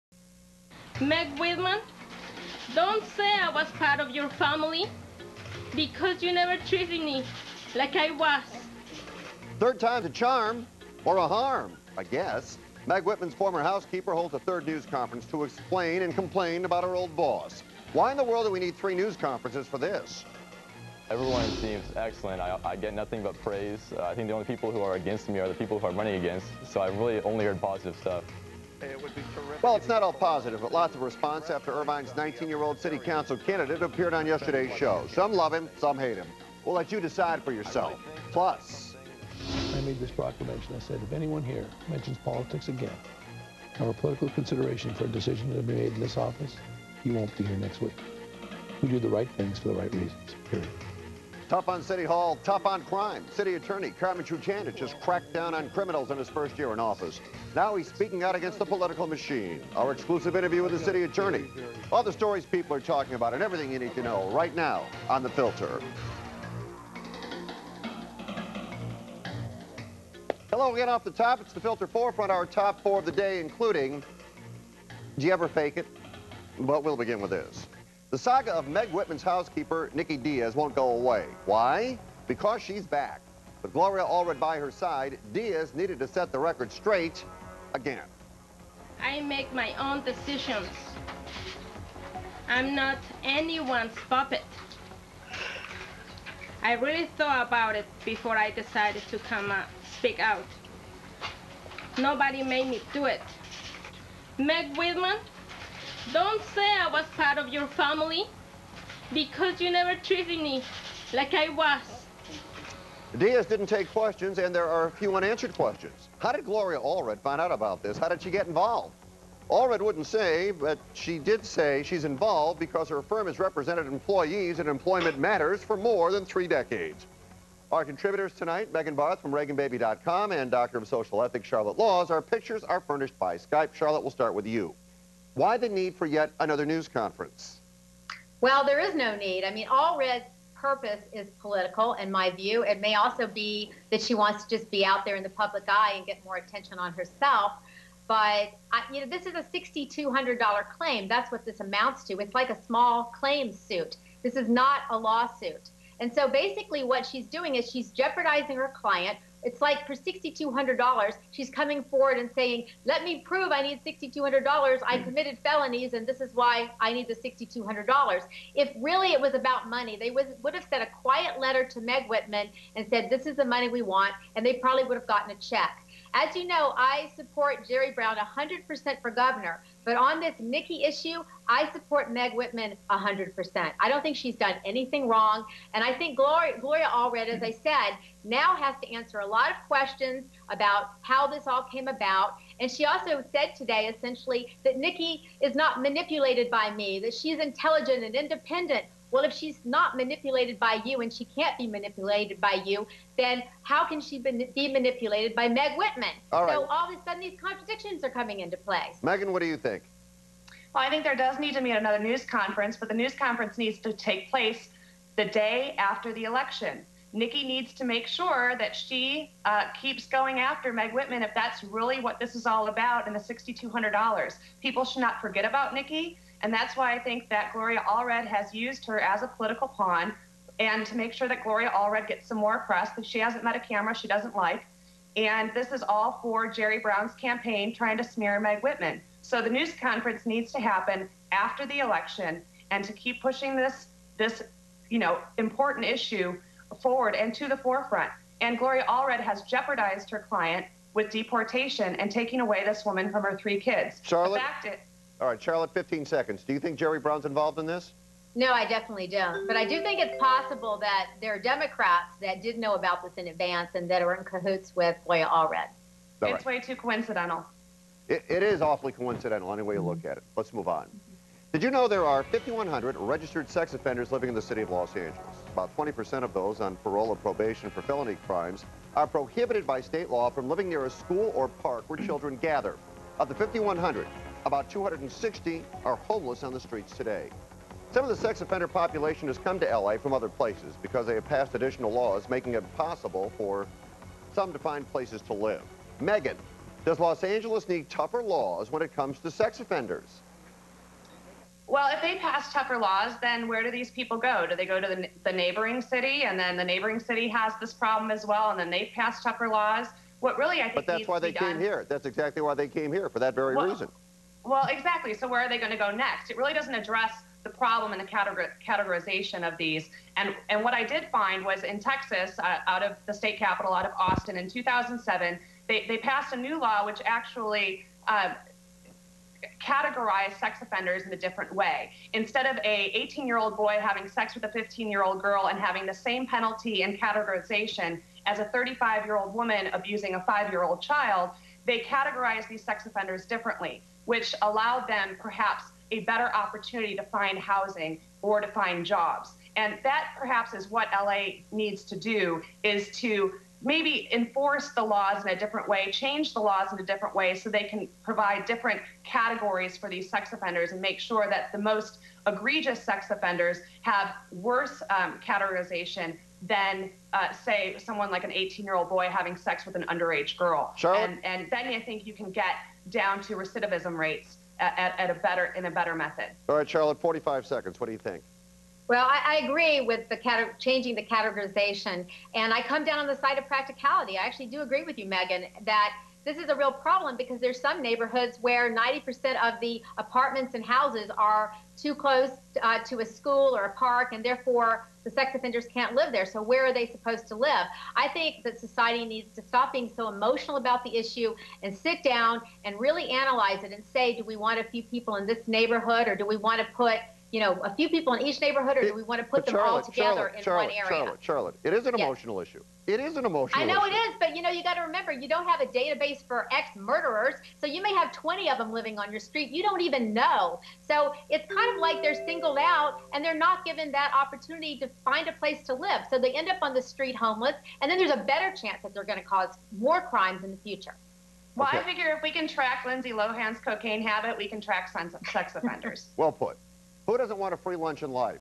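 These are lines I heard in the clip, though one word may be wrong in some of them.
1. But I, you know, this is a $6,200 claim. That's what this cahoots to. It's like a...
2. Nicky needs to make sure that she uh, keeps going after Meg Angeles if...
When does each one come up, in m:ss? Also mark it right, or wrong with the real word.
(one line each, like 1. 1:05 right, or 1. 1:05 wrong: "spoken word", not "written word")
1. 2:28 wrong: "amounts", not "cahoots"
2. 3:37 wrong: "Whitman", not "Angeles".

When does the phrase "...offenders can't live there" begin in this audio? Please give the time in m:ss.
6:35.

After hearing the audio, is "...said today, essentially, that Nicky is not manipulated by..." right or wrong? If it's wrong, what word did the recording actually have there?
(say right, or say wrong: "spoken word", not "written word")
right.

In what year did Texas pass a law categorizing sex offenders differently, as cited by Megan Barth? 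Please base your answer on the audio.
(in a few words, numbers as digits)
2007.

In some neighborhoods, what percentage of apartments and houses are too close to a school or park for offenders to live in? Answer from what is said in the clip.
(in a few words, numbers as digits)
90%.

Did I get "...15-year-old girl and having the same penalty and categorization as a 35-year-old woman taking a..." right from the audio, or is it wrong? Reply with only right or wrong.
wrong.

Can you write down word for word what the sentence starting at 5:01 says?
Well, if they pass tougher laws, then where do these people go?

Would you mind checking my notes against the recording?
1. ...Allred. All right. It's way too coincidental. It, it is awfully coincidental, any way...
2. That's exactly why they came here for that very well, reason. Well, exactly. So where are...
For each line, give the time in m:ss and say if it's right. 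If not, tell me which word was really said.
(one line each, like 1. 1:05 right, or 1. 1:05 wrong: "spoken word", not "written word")
1. 4:25 right
2. 5:11 right.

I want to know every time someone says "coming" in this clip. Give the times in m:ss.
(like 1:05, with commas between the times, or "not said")
2:41, 3:28.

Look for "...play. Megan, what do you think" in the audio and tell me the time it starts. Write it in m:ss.
3:28.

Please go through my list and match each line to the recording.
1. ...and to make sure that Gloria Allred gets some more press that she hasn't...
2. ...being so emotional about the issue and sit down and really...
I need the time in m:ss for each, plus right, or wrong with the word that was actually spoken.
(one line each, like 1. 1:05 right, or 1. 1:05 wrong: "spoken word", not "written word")
1. 3:50 right
2. 6:39 right.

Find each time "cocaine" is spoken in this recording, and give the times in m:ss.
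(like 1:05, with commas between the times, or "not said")
7:13.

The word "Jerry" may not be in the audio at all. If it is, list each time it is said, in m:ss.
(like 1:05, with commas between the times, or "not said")
2:57, 3:56, 4:16.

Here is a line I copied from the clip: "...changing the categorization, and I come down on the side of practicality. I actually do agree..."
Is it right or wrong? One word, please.
right.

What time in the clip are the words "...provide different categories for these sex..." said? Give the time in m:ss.
5:58.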